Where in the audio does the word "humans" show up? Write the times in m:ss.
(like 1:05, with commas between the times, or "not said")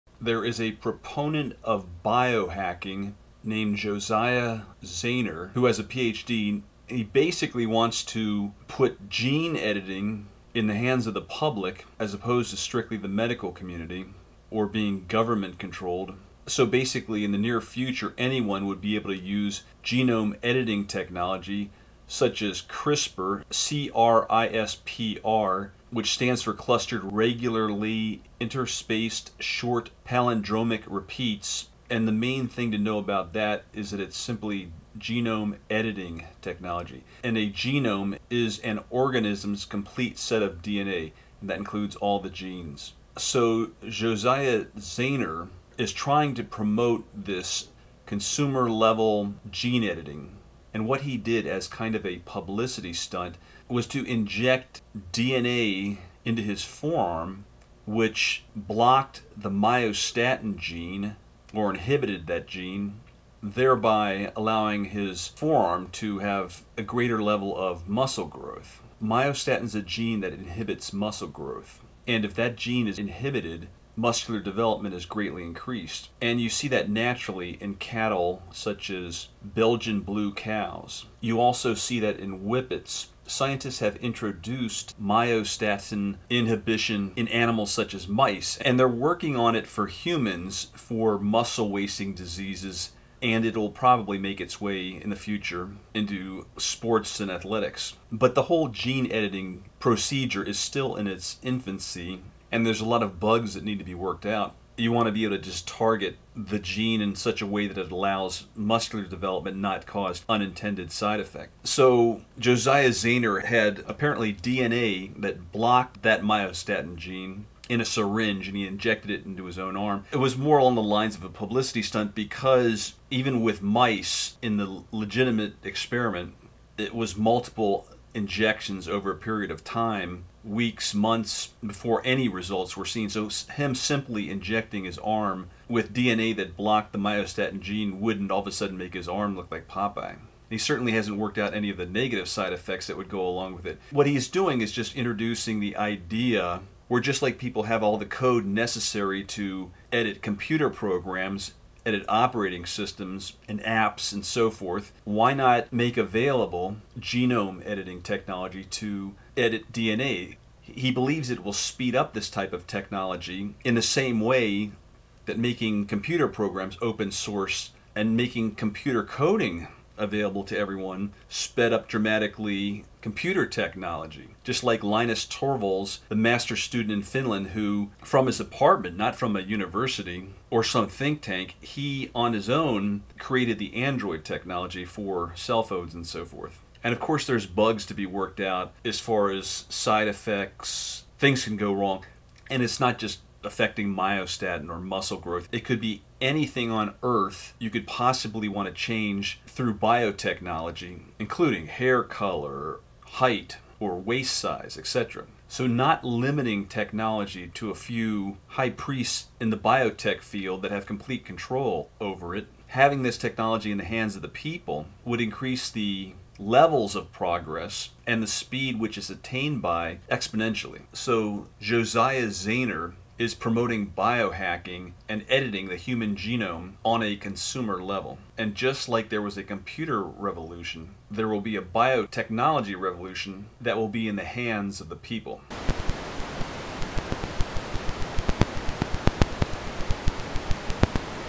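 1:29, 3:45.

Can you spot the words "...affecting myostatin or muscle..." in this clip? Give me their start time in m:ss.
3:13.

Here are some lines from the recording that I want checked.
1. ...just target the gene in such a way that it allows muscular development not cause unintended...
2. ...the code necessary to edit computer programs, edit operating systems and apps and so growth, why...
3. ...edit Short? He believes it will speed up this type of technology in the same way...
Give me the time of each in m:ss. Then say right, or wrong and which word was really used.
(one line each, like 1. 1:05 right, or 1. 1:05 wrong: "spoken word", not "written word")
1. 1:45 right
2. 2:27 wrong: "forth", not "growth"
3. 2:39 wrong: "DNA", not "Short".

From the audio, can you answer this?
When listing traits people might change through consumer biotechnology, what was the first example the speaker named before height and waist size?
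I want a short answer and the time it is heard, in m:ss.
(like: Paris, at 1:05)
hair color, at 3:21.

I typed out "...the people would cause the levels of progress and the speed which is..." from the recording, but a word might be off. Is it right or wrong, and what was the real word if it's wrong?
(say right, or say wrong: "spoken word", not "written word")
wrong: "increase", not "cause".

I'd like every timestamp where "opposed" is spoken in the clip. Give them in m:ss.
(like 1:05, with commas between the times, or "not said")
0:12.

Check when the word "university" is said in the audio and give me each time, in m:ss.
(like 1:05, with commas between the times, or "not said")
2:59.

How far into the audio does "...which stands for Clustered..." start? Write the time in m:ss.
0:25.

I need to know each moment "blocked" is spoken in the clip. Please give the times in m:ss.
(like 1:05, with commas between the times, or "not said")
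0:58, 1:55, 2:16.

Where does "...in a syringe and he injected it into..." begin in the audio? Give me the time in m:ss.
1:57.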